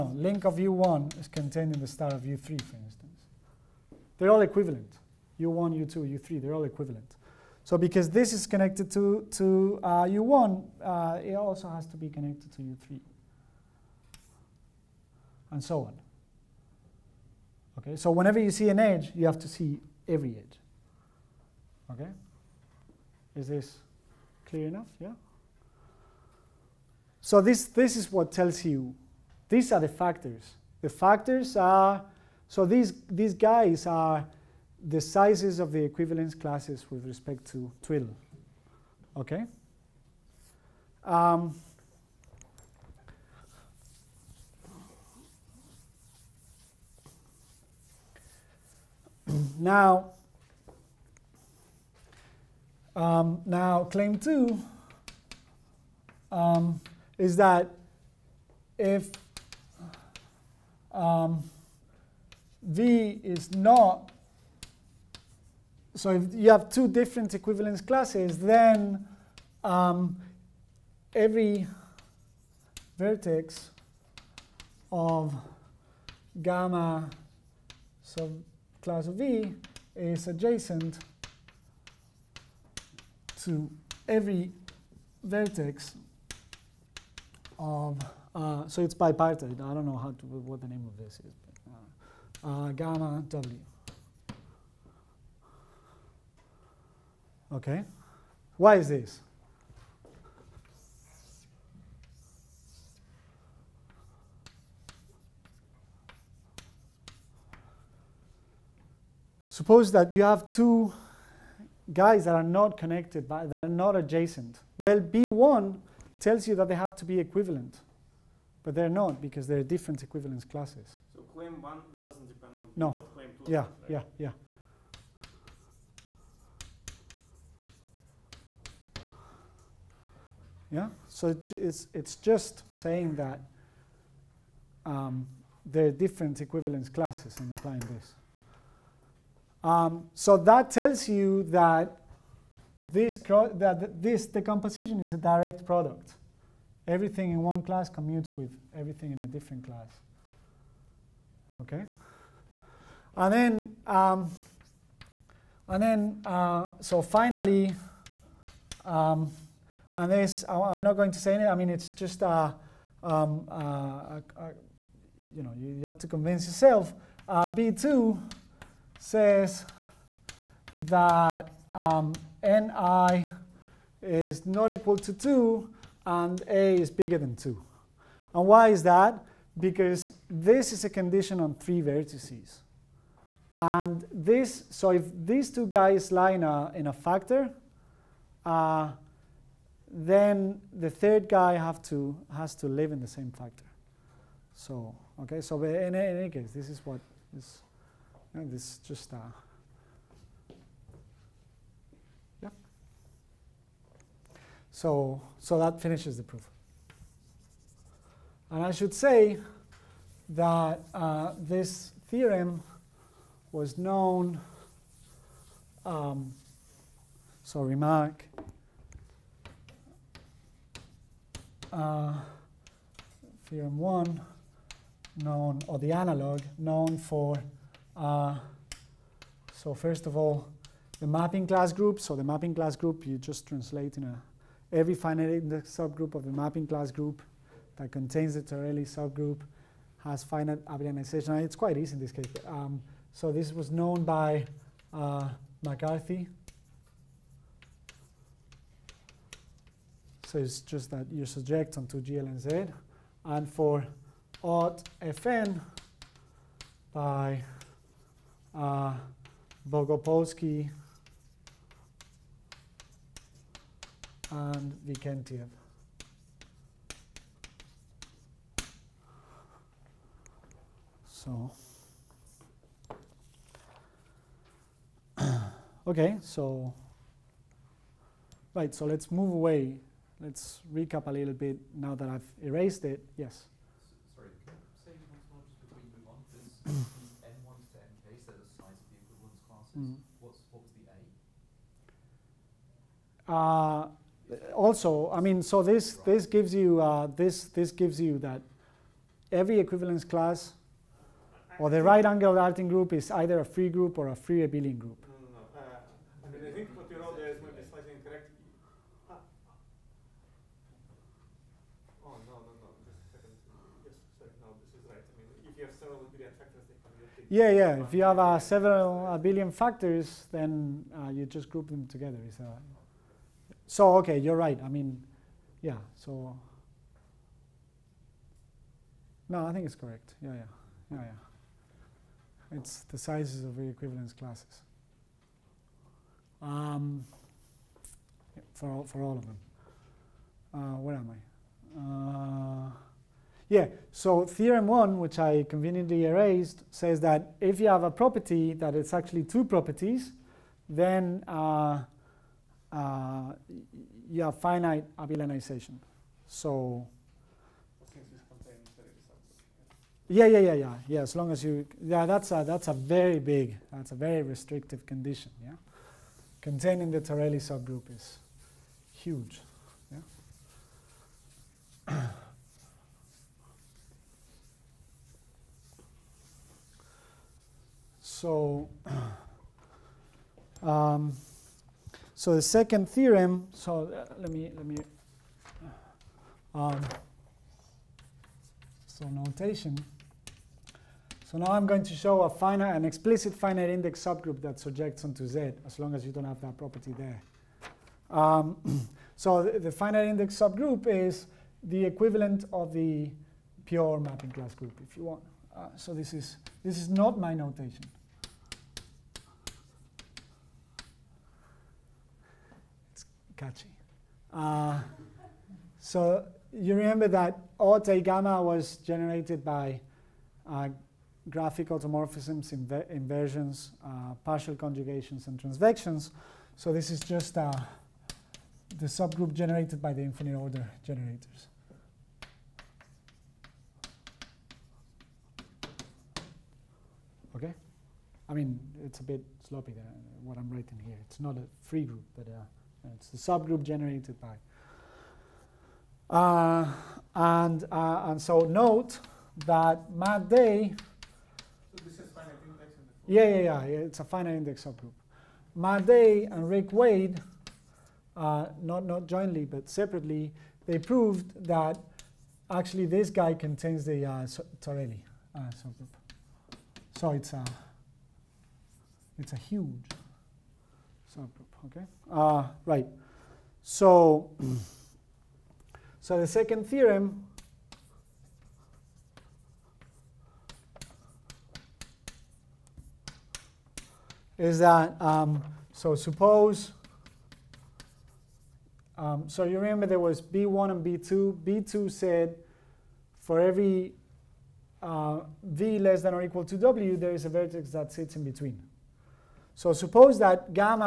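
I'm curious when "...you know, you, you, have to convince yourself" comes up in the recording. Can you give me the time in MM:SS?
02:45.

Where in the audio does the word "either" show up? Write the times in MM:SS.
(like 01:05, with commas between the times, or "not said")
05:03.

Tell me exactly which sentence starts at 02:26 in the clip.
Everything in one class commutes with everything in a different class.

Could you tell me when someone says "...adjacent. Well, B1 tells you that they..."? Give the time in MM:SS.
01:53.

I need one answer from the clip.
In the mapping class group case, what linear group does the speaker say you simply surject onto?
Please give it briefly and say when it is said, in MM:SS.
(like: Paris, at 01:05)
GLNZ, at 04:12.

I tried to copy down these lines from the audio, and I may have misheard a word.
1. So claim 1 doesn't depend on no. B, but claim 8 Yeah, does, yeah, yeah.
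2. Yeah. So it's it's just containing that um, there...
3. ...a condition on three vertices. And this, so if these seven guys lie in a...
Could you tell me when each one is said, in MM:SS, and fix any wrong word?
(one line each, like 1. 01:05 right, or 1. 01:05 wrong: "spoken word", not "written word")
1. 02:01 wrong: "2", not "8"
2. 02:10 wrong: "saying", not "containing"
3. 03:00 wrong: "two", not "seven".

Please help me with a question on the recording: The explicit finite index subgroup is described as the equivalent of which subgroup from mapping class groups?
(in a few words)
pure mapping class group.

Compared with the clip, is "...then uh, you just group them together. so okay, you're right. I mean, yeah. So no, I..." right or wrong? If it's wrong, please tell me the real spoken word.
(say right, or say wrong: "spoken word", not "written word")
right.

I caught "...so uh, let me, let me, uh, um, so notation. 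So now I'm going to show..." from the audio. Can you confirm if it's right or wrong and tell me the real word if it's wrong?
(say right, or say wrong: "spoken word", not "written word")
right.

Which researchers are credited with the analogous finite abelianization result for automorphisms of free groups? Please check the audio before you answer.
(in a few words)
Bogopolski and Vikentiev.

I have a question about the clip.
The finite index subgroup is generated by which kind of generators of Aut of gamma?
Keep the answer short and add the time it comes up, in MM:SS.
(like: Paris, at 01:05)
infinite order generators, at 07:10.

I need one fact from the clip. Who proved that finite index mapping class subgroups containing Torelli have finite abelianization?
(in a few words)
McCarthy.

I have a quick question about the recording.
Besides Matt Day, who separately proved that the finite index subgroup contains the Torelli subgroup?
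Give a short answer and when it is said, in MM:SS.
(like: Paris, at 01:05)
Rick Wade, at 07:36.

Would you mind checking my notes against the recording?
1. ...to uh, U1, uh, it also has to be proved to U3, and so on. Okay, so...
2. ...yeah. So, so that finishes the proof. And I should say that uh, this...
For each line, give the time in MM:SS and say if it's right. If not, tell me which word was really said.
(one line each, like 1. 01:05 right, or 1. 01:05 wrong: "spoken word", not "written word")
1. 00:09 wrong: "connected", not "proved"
2. 03:22 right.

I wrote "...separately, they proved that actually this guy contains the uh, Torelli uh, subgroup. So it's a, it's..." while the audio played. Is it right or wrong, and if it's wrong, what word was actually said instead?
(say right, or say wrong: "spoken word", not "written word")
right.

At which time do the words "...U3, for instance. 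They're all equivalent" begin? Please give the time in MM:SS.
00:02.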